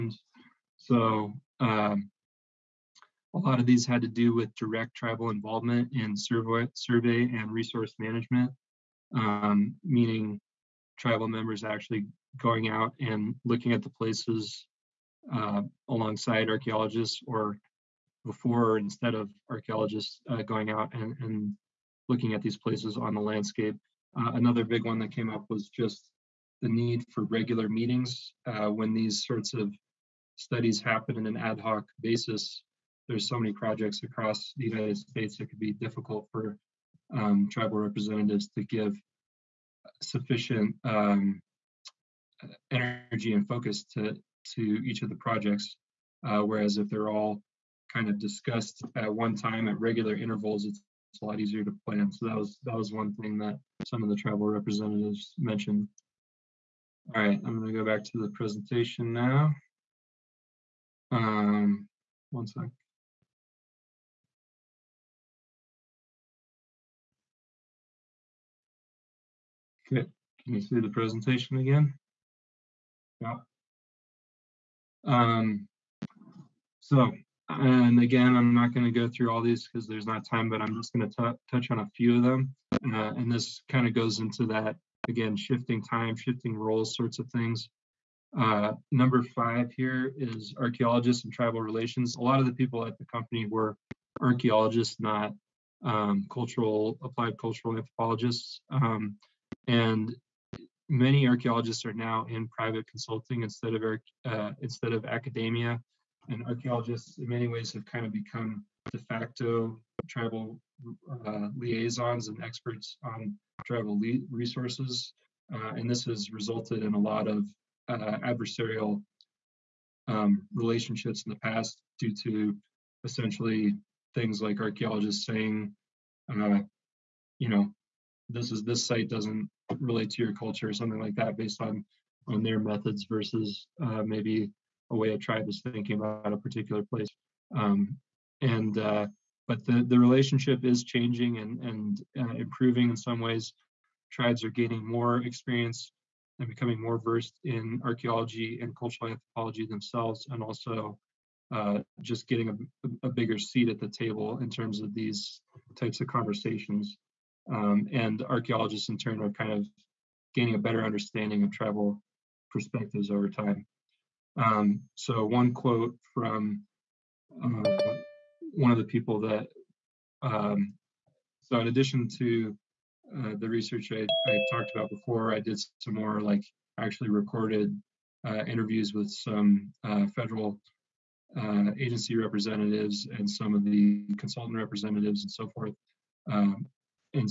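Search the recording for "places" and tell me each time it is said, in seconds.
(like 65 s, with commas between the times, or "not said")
13 s, 22 s, 136 s.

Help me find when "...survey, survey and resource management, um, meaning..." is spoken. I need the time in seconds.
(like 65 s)
6 s.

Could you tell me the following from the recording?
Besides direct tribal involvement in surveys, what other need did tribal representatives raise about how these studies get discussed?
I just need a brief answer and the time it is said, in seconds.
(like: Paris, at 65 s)
Regular meetings, at 27 s.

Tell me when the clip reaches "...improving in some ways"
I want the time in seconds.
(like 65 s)
142 s.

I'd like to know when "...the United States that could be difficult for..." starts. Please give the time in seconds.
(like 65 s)
34 s.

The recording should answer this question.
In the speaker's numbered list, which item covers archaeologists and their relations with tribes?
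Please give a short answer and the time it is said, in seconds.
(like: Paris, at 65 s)
5, at 88 s.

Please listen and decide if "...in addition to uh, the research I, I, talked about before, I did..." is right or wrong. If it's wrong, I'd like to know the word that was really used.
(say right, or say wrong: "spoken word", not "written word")
right.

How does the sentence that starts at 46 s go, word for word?
Uh, whereas if they're all kind of discussed at one time at regular intervals, it's, it's a lot easier to plan.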